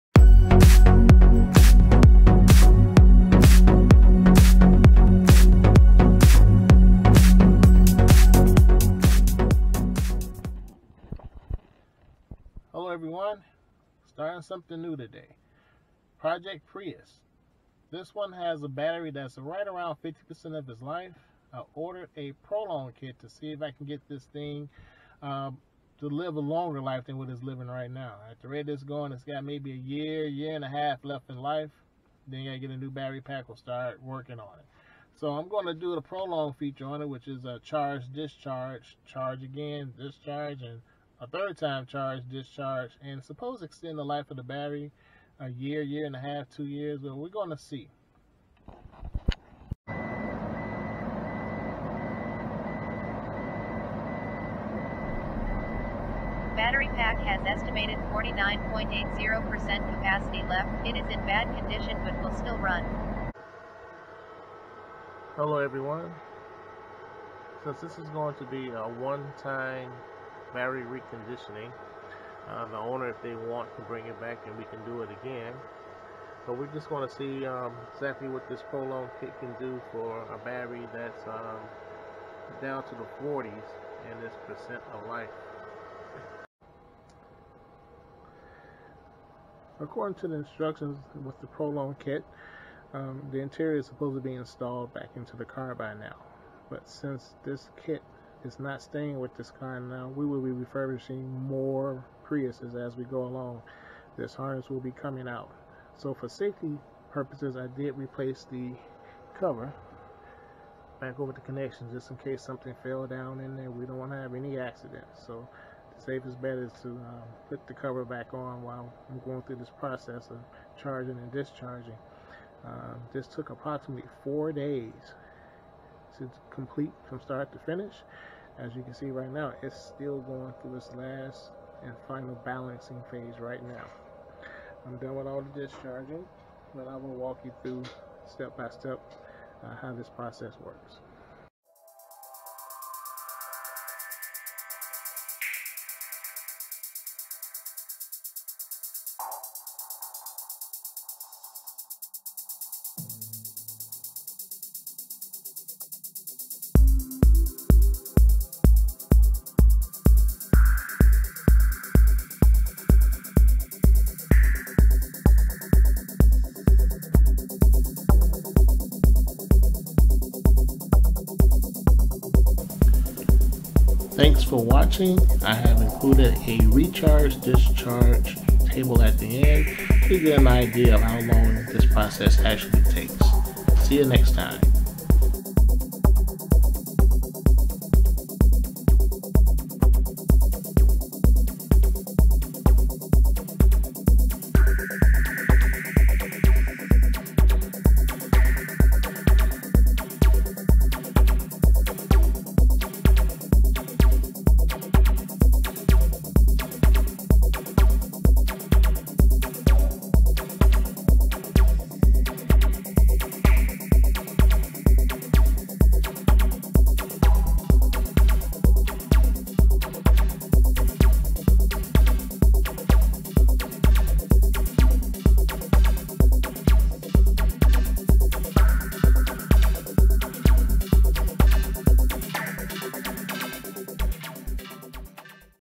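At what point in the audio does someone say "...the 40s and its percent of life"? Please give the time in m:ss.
1:22.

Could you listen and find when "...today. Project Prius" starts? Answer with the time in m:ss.
0:14.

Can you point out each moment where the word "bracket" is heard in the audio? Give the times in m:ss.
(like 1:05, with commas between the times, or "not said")
not said.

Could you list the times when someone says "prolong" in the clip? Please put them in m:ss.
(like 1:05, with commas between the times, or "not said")
0:22, 0:36, 1:18, 1:31.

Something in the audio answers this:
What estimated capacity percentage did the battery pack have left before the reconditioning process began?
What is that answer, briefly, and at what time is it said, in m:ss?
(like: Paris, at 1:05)
49.80%, at 0:58.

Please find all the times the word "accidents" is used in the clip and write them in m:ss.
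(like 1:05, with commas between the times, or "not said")
1:54.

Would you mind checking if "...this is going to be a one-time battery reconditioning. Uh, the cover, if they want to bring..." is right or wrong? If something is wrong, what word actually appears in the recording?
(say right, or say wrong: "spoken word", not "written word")
wrong: "owner", not "cover".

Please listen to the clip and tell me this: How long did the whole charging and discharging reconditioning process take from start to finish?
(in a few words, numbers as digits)
four days.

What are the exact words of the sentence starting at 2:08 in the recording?
As you can see right now, it's still going through its last and final balancing phase right now.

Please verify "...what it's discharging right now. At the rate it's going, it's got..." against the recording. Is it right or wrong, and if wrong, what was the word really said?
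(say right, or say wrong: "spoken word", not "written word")
wrong: "living", not "discharging".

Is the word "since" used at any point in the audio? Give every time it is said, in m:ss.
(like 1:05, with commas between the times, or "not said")
1:07, 1:36.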